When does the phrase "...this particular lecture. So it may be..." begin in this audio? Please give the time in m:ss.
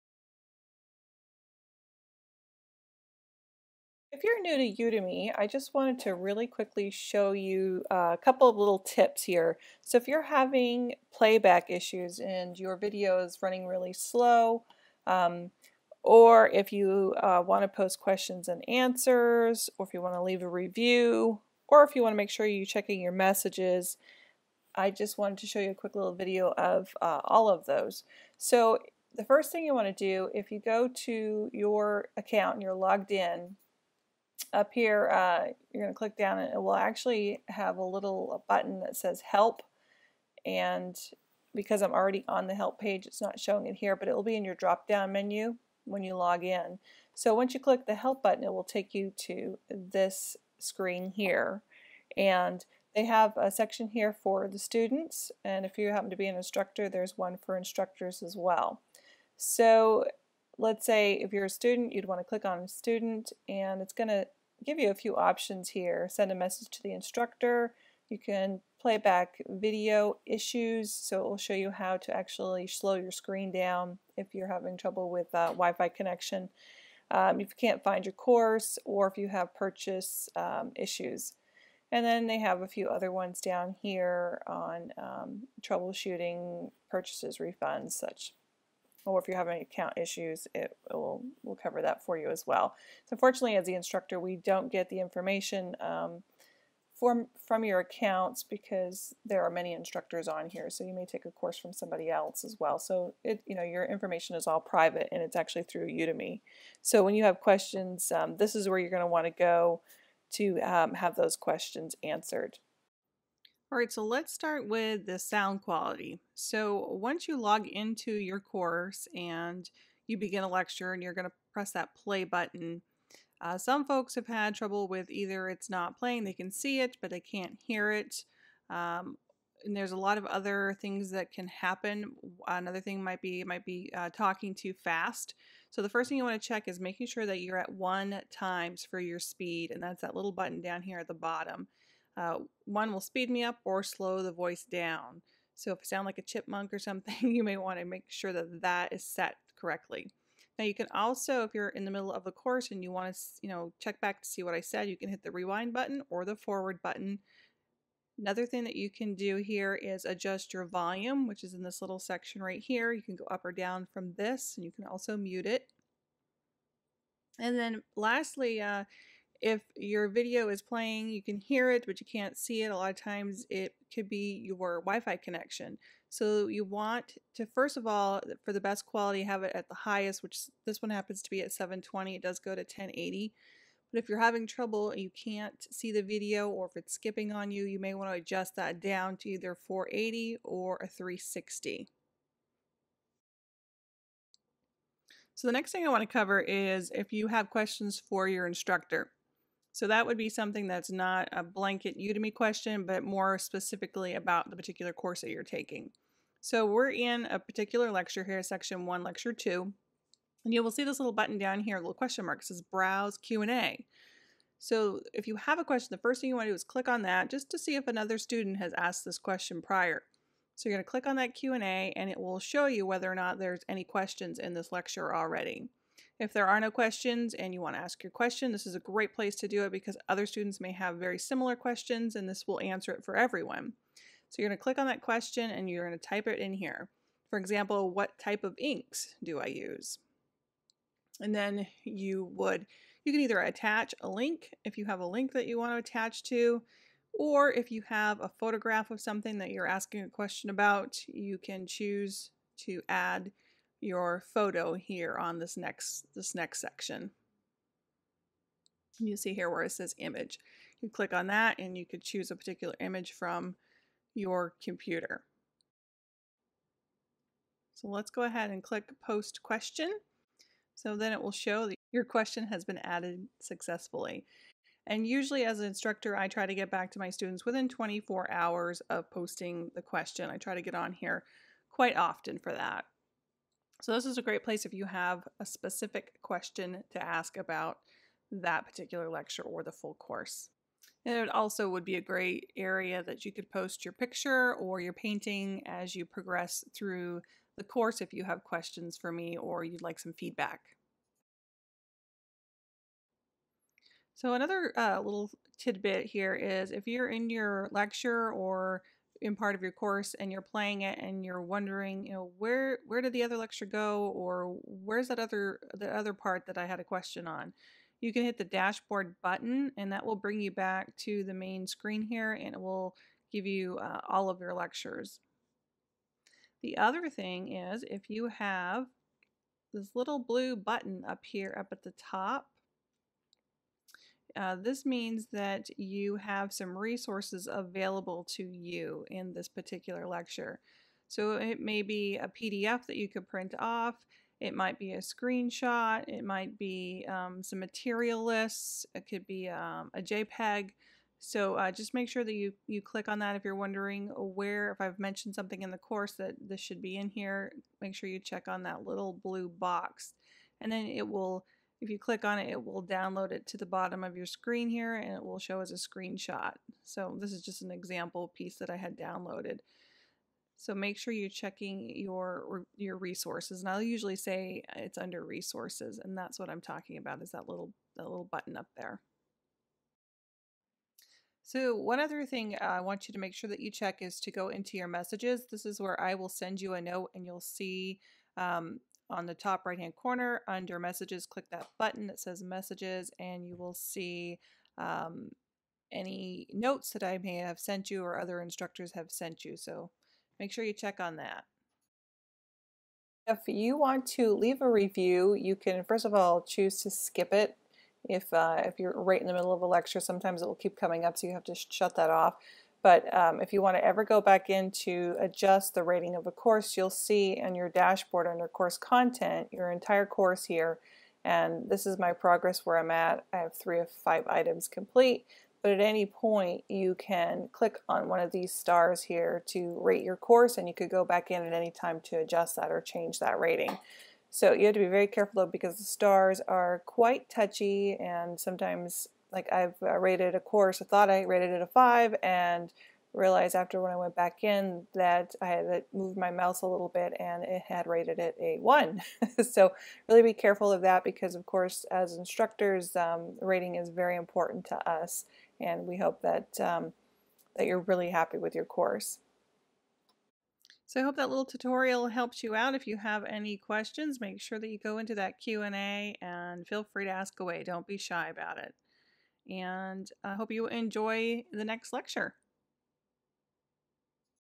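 5:39.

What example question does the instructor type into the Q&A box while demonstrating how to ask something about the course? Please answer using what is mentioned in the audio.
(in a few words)
What type of inks do I use?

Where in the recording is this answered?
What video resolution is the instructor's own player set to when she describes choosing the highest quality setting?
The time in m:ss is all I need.
3:01.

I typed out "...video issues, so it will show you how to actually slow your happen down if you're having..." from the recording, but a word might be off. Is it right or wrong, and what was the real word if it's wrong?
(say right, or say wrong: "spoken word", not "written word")
wrong: "screen", not "happen".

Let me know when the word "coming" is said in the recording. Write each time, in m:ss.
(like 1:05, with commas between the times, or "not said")
6:50.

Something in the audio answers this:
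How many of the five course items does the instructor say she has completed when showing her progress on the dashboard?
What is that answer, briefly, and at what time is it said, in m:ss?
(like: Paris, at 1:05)
3, at 7:03.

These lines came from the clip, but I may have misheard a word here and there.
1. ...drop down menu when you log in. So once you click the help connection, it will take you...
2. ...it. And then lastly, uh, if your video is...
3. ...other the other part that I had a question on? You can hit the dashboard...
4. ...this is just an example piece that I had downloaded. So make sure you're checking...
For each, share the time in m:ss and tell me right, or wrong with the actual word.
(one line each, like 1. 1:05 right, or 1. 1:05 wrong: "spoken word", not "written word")
1. 0:44 wrong: "button", not "connection"
2. 2:45 right
3. 5:15 right
4. 6:07 right.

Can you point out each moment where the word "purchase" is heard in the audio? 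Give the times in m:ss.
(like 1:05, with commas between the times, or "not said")
1:19, 1:26.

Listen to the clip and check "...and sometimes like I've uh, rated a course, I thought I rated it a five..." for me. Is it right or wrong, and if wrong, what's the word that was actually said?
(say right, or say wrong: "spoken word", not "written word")
right.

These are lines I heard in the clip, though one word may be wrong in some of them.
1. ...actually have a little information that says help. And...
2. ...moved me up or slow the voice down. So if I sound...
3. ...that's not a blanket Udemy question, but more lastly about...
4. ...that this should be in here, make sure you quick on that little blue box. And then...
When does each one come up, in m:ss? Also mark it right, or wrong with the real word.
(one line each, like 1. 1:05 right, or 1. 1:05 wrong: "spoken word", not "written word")
1. 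0:36 wrong: "button", not "information"
2. 2:22 wrong: "speed", not "moved"
3. 3:20 wrong: "specifically", not "lastly"
4. 5:56 wrong: "check", not "quick".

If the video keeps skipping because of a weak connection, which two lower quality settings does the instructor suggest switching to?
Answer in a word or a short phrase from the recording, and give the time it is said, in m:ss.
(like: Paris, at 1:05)
480 or 360, at 3:09.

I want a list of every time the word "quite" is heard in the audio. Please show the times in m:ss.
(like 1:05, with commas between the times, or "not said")
4:41, 7:16.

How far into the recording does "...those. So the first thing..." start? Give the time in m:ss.
0:27.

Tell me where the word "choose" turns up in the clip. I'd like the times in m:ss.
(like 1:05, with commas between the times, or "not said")
4:11, 4:22, 6:46.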